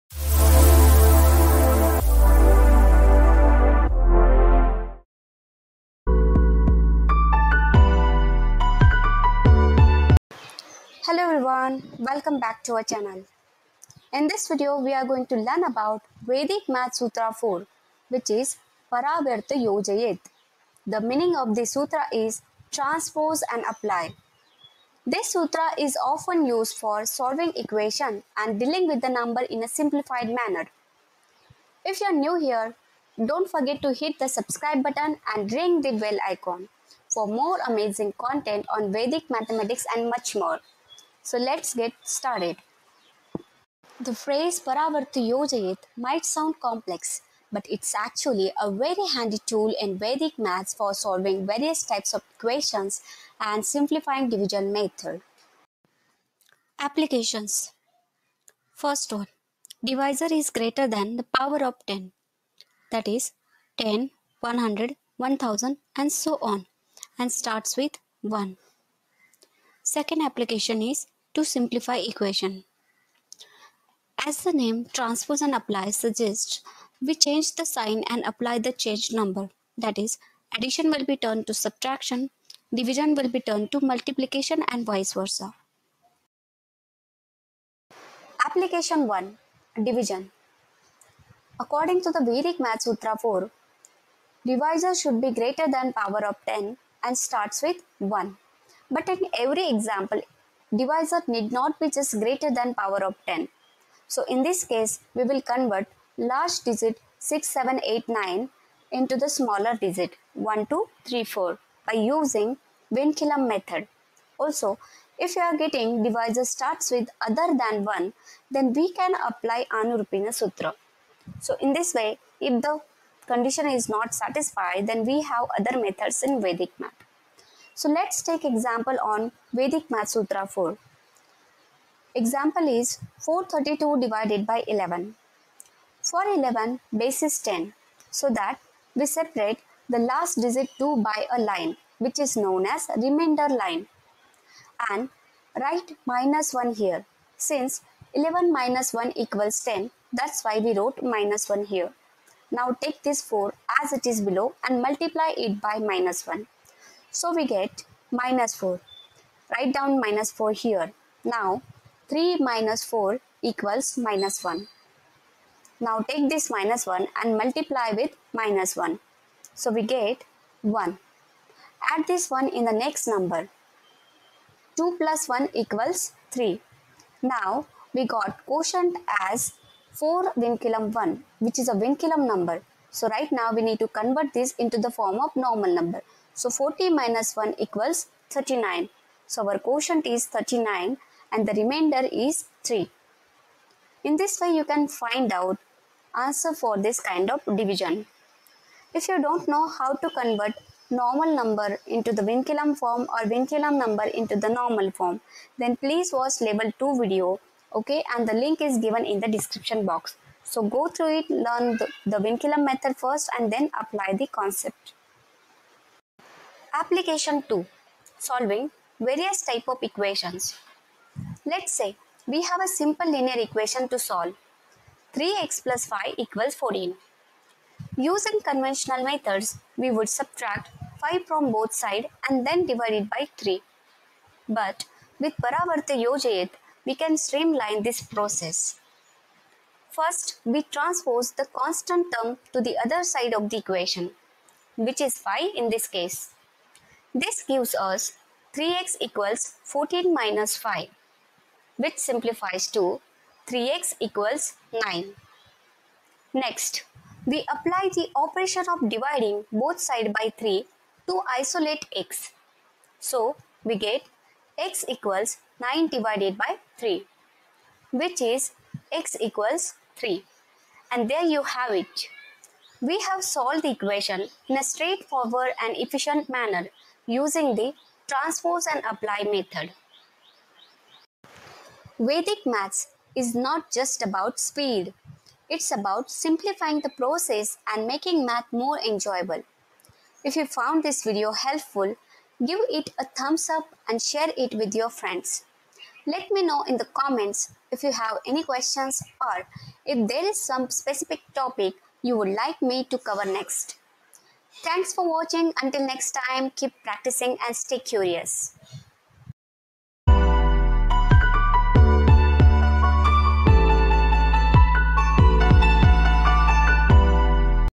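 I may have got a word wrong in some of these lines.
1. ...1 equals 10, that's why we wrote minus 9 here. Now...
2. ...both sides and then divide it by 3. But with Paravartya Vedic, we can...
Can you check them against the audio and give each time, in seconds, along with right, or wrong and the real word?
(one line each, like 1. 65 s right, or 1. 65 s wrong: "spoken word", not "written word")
1. 148 s wrong: "1", not "9"
2. 231 s wrong: "Yojayet", not "Vedic".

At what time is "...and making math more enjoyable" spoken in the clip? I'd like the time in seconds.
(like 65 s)
287 s.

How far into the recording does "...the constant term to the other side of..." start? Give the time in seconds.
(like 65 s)
241 s.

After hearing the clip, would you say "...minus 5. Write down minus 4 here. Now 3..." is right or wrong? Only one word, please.
wrong.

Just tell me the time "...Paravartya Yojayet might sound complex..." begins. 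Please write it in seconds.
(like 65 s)
44 s.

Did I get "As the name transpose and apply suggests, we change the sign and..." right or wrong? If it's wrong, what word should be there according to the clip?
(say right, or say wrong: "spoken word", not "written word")
right.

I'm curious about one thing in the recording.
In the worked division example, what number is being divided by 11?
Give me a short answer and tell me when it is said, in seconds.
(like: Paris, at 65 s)
432, at 133 s.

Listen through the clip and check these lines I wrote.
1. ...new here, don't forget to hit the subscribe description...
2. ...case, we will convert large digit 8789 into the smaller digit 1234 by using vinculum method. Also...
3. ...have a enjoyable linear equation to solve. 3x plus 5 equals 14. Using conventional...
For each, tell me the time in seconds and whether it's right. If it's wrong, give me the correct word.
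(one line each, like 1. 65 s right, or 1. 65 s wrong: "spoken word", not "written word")
1. 32 s wrong: "button", not "description"
2. 104 s wrong: "6789", not "8789"
3. 222 s wrong: "simple", not "enjoyable".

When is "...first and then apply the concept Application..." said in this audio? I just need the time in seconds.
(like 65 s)
212 s.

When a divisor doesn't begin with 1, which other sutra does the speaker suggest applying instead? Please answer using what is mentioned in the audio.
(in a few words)
Anurupyena Sutra.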